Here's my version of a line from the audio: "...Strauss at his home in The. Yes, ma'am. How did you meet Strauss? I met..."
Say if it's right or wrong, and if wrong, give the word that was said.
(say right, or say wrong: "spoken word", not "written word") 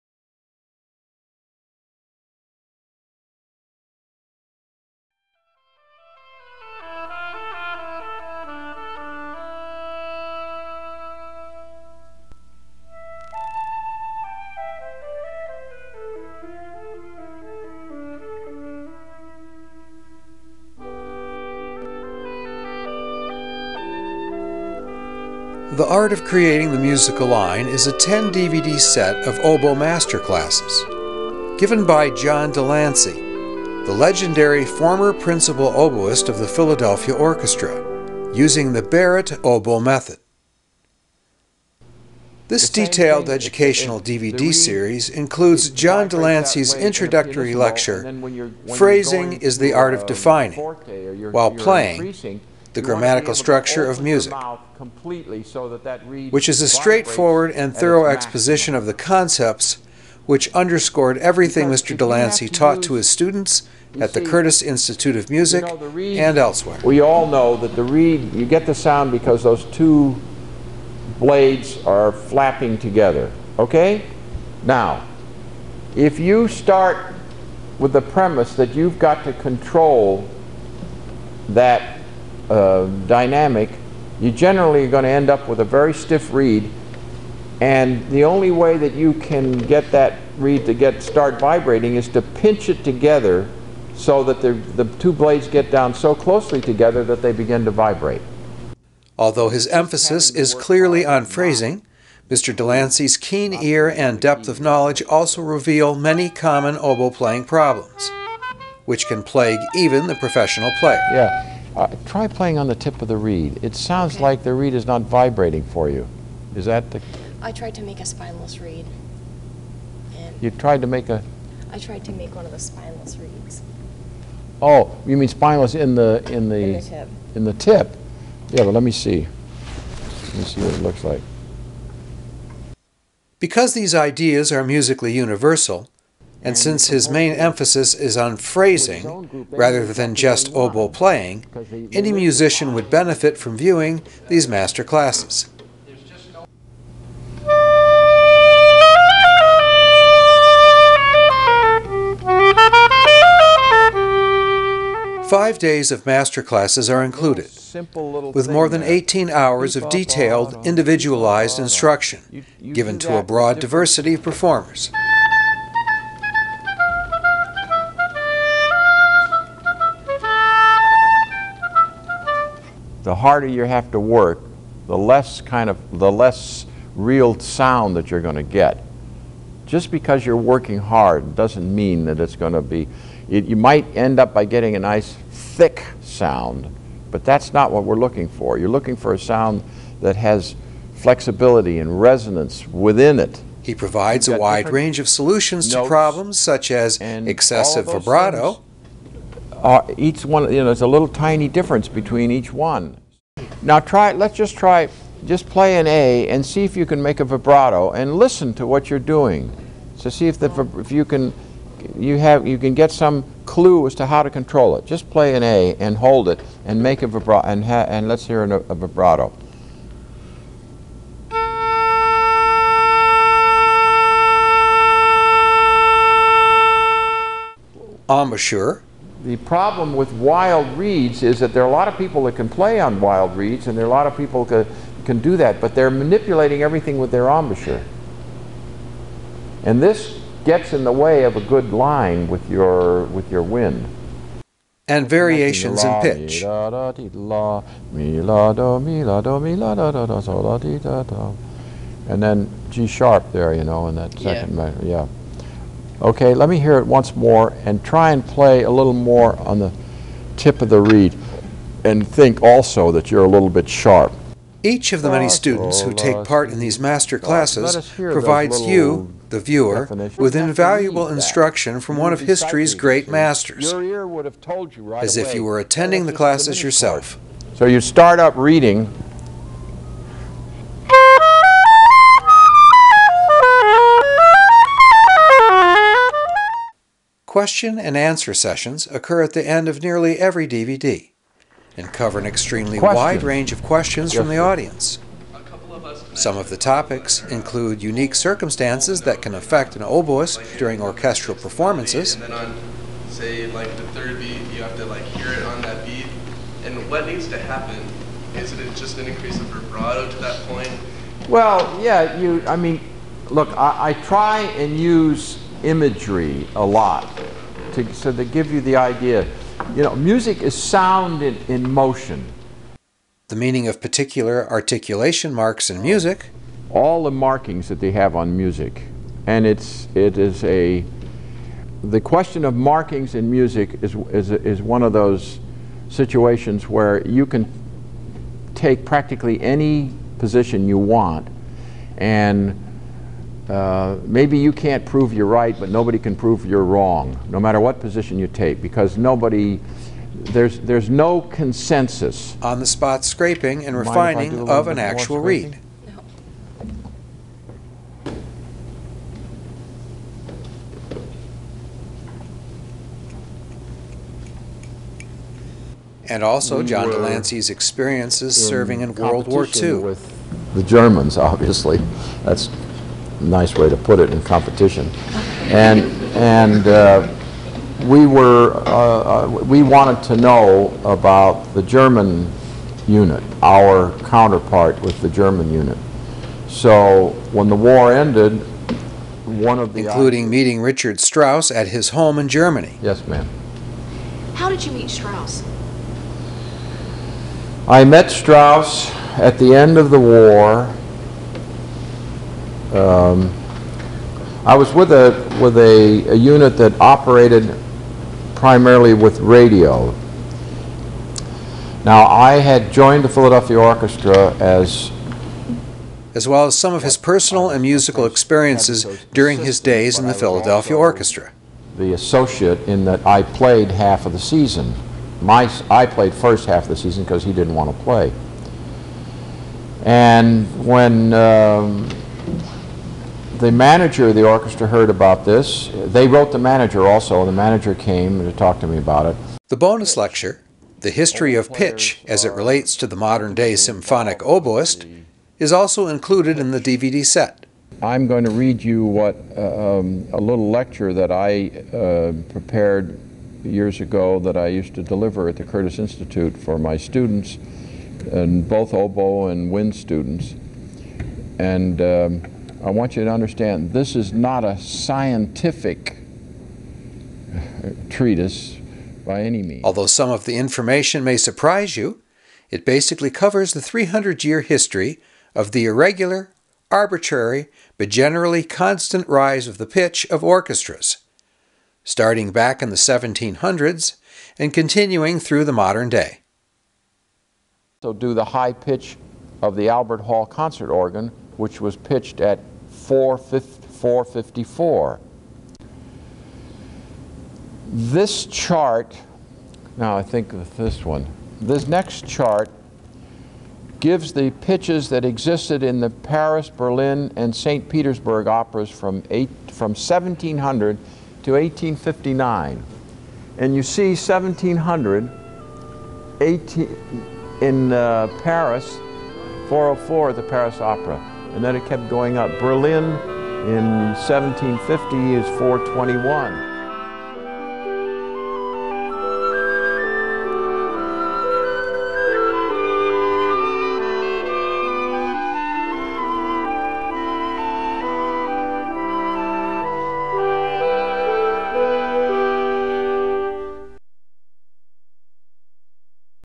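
wrong: "Germany", not "The".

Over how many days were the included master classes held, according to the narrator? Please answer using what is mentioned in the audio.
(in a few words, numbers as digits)
5.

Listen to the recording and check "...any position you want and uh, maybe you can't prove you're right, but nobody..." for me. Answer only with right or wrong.
right.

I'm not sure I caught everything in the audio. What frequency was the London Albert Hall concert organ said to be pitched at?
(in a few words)
454.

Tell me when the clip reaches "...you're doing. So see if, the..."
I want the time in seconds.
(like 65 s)
208 s.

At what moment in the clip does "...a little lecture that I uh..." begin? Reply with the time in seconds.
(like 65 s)
450 s.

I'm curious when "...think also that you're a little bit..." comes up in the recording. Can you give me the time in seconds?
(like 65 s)
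262 s.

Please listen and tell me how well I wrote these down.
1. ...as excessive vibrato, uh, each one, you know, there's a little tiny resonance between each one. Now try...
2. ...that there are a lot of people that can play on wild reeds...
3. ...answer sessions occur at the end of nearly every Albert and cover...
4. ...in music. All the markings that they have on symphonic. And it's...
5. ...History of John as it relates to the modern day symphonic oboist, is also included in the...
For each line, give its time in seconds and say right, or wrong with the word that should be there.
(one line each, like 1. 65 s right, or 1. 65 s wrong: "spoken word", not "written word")
1. 196 s wrong: "difference", not "resonance"
2. 231 s right
3. 287 s wrong: "DVD", not "Albert"
4. 325 s wrong: "music", not "symphonic"
5. 440 s wrong: "Pitch", not "John".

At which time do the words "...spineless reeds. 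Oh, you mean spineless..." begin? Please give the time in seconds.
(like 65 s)
122 s.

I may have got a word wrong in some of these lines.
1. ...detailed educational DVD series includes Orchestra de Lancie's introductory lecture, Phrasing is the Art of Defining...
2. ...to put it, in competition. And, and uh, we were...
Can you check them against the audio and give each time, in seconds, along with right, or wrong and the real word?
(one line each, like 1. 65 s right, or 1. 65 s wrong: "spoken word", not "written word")
1. 42 s wrong: "John", not "Orchestra"
2. 373 s right.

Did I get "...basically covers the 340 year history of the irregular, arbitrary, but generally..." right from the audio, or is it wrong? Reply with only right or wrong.
wrong.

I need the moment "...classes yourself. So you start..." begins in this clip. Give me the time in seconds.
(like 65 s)
276 s.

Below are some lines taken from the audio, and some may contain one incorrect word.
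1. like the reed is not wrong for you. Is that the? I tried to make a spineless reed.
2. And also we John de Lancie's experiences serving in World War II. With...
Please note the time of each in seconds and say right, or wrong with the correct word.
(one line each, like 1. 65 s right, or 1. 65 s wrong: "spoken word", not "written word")
1. 114 s wrong: "vibrating", not "wrong"
2. 366 s right.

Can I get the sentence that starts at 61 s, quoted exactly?
de Lancie taught to his students at the Curtis Institute of Music and elsewhere.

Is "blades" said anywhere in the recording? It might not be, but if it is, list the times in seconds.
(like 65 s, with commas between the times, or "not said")
71 s, 95 s.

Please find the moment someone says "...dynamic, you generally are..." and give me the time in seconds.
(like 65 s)
83 s.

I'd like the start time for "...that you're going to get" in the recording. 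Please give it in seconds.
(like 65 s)
177 s.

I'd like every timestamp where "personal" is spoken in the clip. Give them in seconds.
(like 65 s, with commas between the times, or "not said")
416 s.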